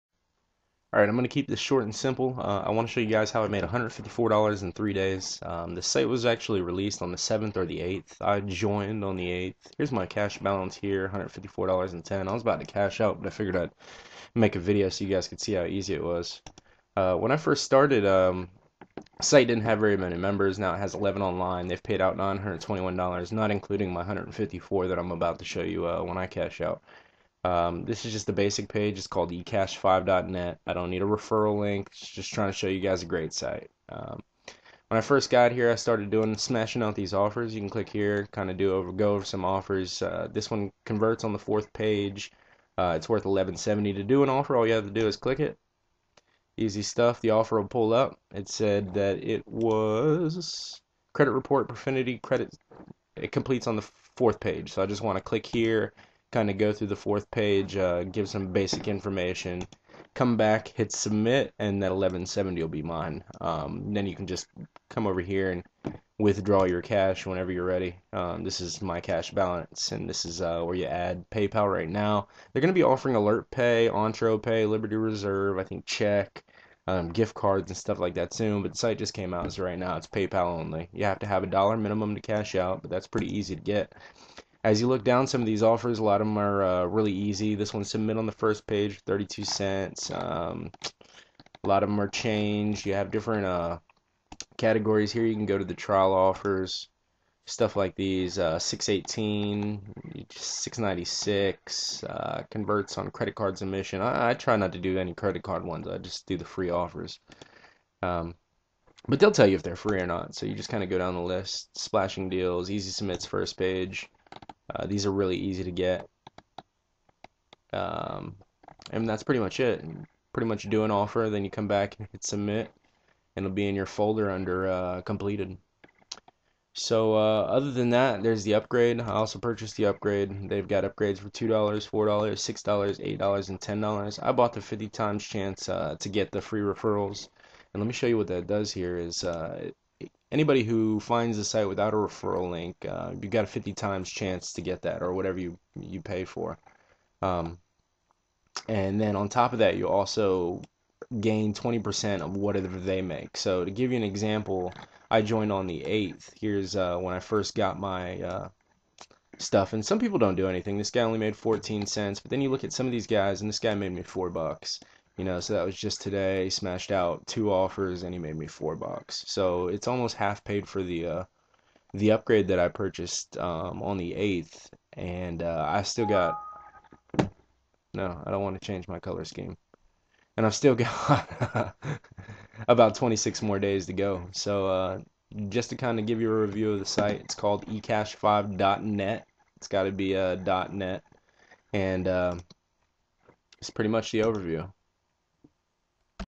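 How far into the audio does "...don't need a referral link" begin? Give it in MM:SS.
00:30.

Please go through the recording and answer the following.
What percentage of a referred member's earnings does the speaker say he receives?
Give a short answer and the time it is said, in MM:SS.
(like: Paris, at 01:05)
20%, at 02:31.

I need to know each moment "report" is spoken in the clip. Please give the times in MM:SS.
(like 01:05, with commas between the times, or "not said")
00:51.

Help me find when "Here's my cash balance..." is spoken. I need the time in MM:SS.
00:09.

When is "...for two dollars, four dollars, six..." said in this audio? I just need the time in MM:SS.
02:11.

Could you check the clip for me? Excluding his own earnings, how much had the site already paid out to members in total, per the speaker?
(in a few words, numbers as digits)
$921.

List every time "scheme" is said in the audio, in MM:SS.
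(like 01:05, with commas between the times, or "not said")
02:59.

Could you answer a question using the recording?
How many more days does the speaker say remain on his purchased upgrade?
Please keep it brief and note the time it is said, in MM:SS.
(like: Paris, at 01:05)
26, at 03:02.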